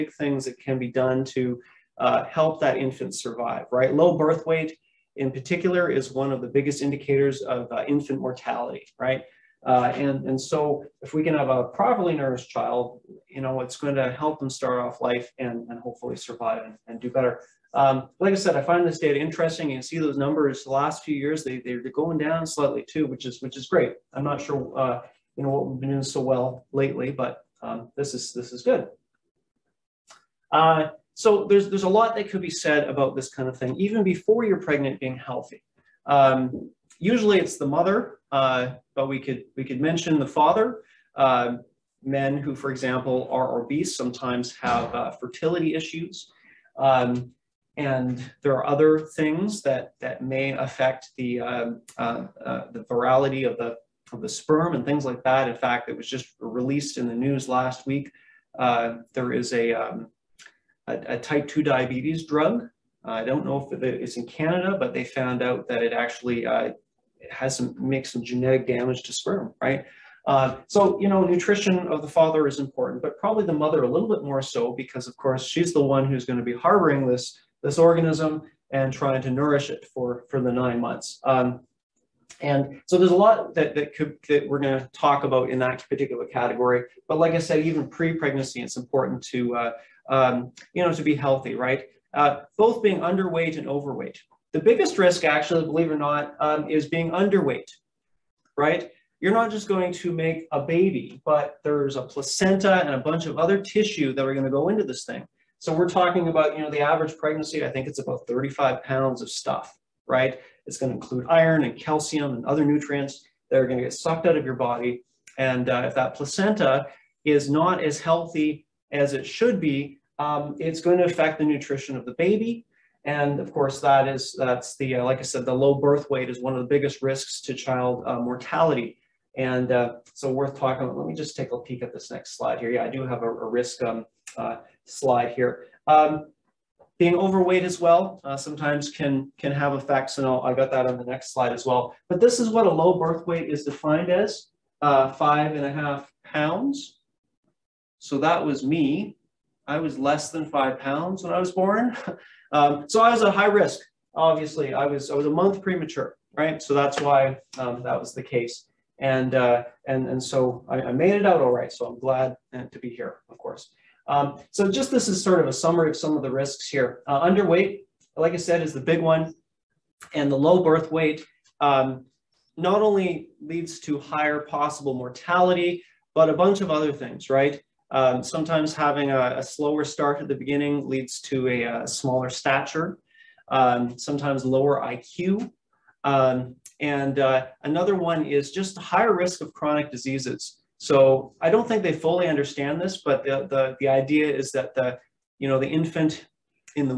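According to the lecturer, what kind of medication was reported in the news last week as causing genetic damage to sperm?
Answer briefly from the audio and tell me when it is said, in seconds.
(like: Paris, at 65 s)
type 2 diabetes drug, at 61 s.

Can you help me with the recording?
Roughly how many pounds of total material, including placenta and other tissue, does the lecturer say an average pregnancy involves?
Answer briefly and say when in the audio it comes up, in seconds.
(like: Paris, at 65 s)
35 pounds, at 108 s.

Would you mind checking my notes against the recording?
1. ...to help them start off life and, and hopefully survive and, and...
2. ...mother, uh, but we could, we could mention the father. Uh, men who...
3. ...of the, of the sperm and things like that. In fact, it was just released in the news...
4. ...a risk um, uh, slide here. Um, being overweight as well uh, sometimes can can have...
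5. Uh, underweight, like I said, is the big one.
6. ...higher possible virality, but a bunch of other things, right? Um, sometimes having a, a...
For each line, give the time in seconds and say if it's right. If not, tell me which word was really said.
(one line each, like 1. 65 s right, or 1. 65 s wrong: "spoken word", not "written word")
1. 13 s right
2. 37 s right
3. 53 s right
4. 133 s right
5. 167 s right
6. 173 s wrong: "mortality", not "virality".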